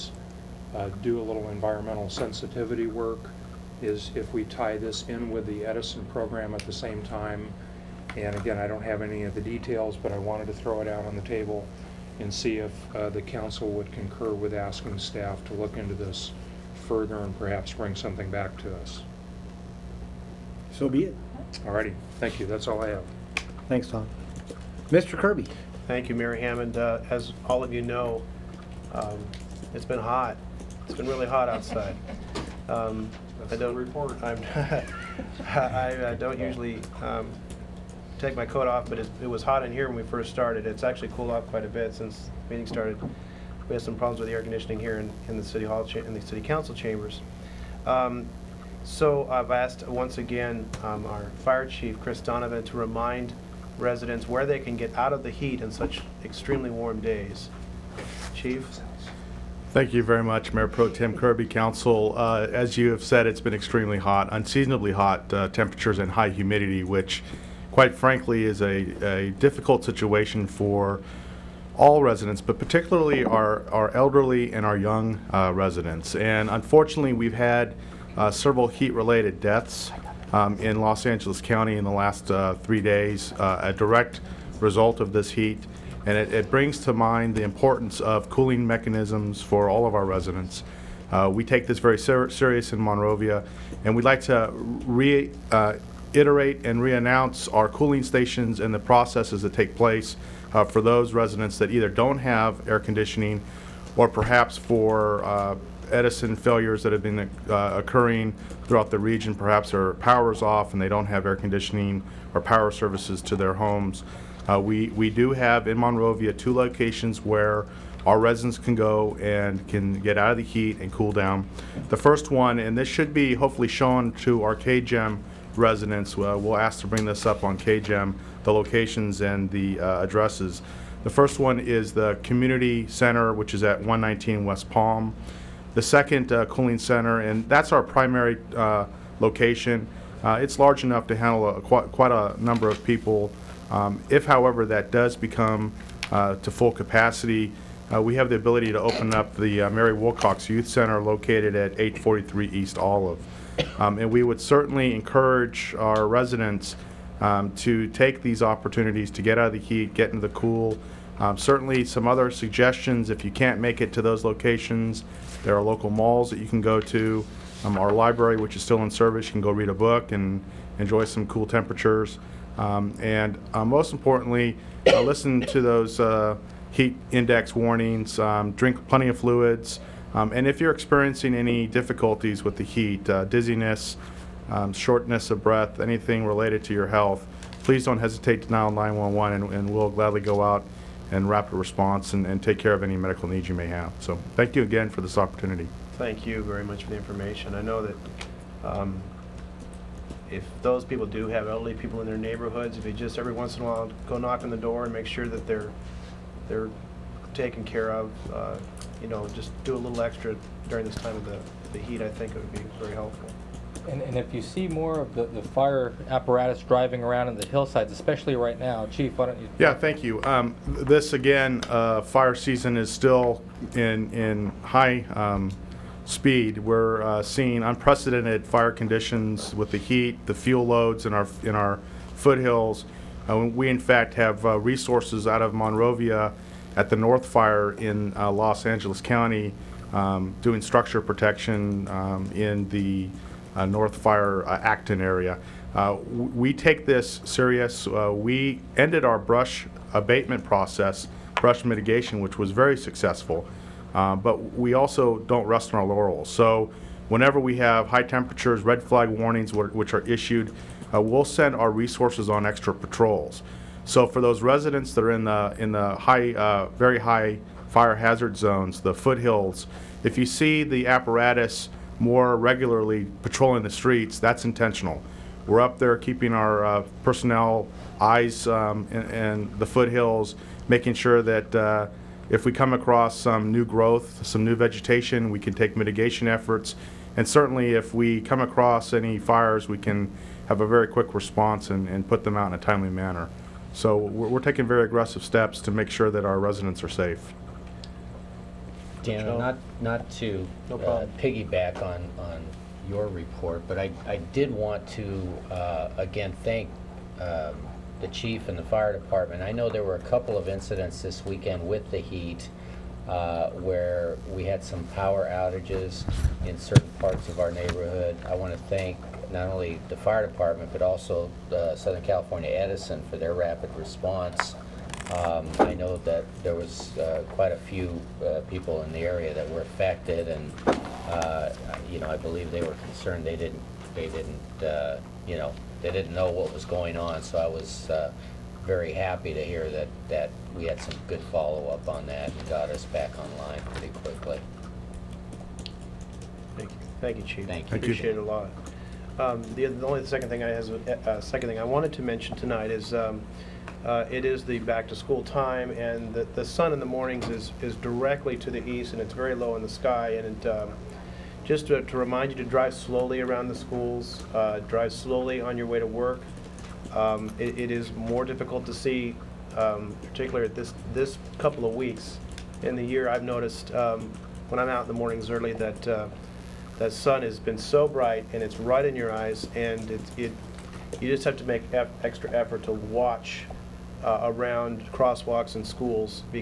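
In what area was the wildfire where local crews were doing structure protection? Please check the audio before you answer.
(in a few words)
Acton.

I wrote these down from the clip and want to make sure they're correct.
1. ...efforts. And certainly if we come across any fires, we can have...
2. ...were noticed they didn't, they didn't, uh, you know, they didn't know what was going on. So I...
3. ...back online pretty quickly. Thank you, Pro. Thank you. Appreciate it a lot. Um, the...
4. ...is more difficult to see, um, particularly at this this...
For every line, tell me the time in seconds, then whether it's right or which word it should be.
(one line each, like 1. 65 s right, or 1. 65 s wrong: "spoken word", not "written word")
1. 286 s right
2. 332 s wrong: "concerned", not "noticed"
3. 342 s wrong: "Chief", not "Pro"
4. 367 s right.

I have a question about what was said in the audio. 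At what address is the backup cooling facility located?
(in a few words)
843 East Olive.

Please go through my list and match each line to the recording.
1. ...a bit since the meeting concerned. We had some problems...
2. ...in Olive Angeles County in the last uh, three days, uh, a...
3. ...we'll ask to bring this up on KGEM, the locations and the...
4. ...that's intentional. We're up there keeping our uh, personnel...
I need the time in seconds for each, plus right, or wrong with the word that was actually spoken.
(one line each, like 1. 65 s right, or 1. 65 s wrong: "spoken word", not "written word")
1. 41 s wrong: "started", not "concerned"
2. 80 s wrong: "Los", not "Olive"
3. 126 s right
4. 274 s right.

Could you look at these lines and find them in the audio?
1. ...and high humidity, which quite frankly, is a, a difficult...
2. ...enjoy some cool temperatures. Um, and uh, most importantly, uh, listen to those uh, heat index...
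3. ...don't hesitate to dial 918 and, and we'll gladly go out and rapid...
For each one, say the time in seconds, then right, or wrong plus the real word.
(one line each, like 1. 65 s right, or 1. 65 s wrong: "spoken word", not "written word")
1. 65 s right
2. 170 s right
3. 187 s wrong: "911", not "918".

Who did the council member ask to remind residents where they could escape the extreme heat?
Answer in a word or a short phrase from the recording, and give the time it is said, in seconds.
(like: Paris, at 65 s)
Chris Donovan, at 51 s.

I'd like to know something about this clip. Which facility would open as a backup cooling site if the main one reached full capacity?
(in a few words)
Mary Wilcox Youth Center.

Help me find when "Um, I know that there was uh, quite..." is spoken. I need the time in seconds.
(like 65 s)
325 s.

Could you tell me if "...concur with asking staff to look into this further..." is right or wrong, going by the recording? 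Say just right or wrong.
right.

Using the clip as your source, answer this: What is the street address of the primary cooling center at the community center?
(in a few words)
119 West Palm.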